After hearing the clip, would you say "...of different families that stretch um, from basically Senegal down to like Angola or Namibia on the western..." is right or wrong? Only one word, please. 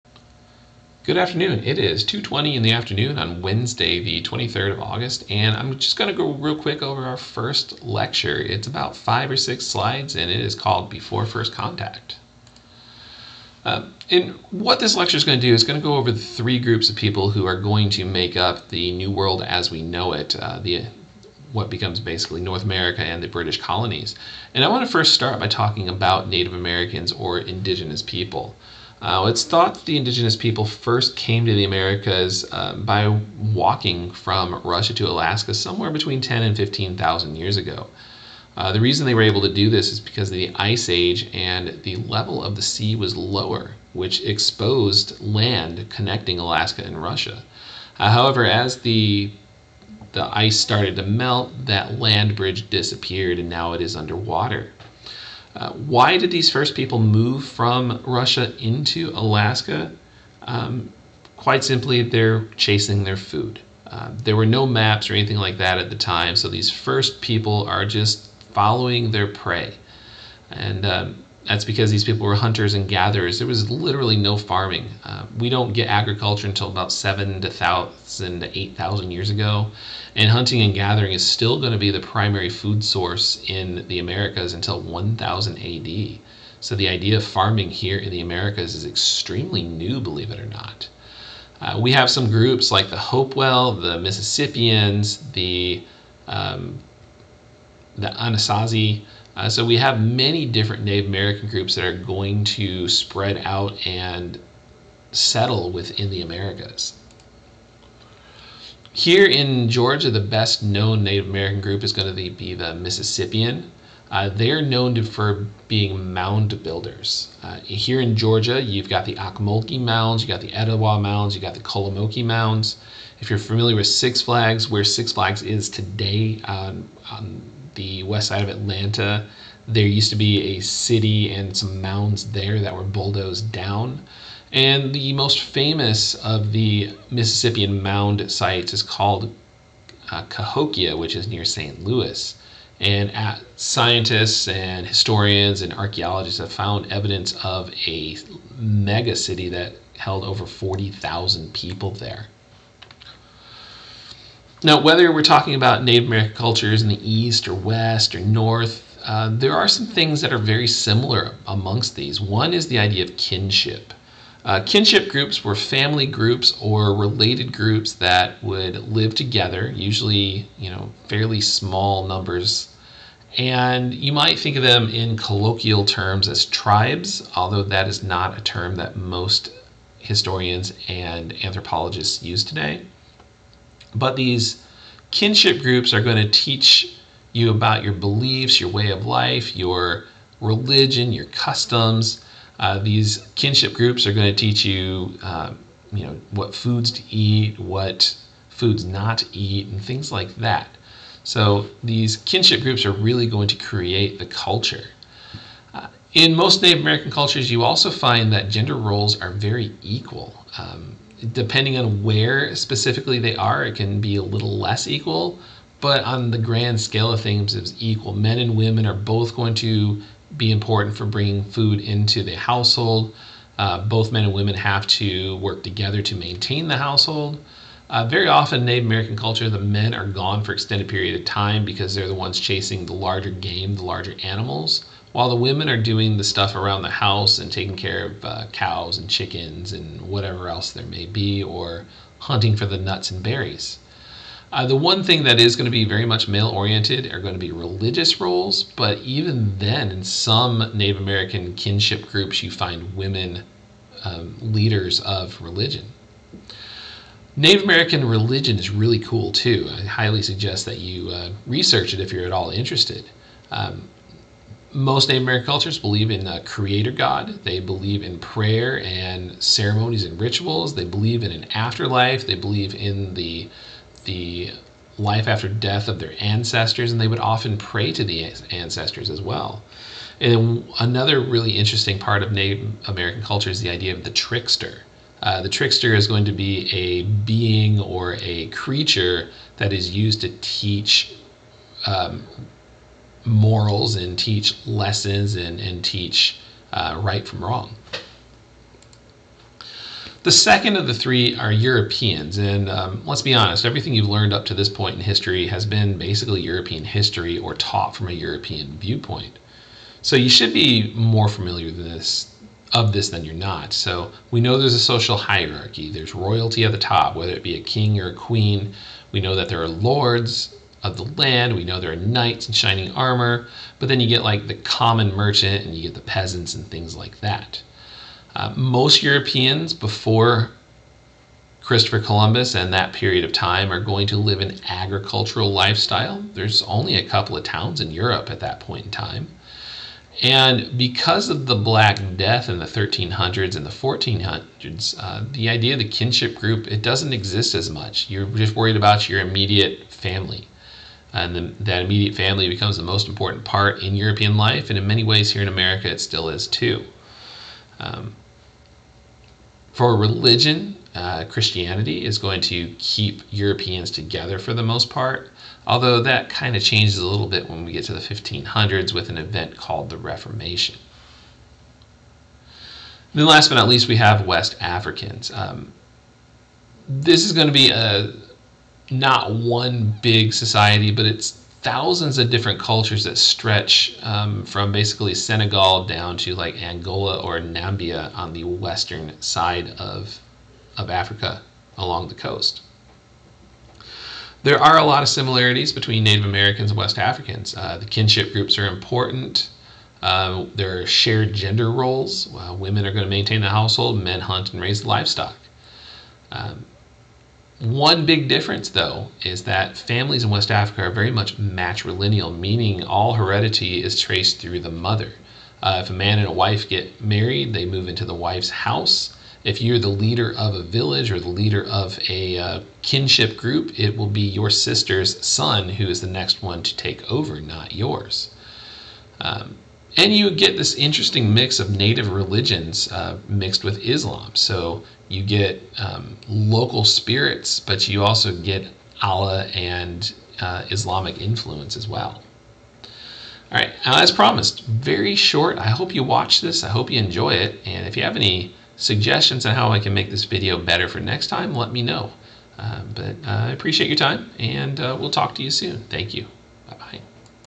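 wrong.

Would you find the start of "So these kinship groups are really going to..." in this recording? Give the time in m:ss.
3:21.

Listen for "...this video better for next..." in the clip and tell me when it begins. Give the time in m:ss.
7:30.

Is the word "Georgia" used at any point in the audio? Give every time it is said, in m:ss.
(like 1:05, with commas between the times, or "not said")
1:49, 1:58.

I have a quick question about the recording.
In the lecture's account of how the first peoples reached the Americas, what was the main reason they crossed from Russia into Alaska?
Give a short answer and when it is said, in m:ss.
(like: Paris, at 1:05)
Chasing their food, at 1:02.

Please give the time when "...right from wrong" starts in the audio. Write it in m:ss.
4:57.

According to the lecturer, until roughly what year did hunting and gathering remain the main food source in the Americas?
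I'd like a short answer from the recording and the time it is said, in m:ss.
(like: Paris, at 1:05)
1000 AD, at 1:24.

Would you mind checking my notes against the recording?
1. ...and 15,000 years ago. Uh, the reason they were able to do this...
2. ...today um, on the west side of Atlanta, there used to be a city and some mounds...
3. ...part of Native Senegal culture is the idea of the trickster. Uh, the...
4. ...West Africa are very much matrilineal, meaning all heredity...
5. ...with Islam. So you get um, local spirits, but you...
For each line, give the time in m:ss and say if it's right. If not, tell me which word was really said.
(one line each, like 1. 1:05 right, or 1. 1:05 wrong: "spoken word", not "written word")
1. 0:36 right
2. 2:05 right
3. 4:41 wrong: "American", not "Senegal"
4. 6:50 right
5. 7:13 right.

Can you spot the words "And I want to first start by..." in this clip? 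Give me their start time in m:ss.
0:24.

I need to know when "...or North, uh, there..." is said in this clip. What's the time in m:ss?
2:38.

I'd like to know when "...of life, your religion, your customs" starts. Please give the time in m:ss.
3:08.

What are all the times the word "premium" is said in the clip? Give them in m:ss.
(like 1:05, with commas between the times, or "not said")
not said.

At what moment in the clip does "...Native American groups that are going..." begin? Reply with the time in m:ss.
1:40.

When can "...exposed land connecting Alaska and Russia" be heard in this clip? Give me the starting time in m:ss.
0:44.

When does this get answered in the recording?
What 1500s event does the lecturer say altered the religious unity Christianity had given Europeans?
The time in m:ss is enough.
6:09.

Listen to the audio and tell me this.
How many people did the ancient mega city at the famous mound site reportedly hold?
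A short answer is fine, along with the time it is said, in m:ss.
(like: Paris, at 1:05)
Over 40,000, at 2:30.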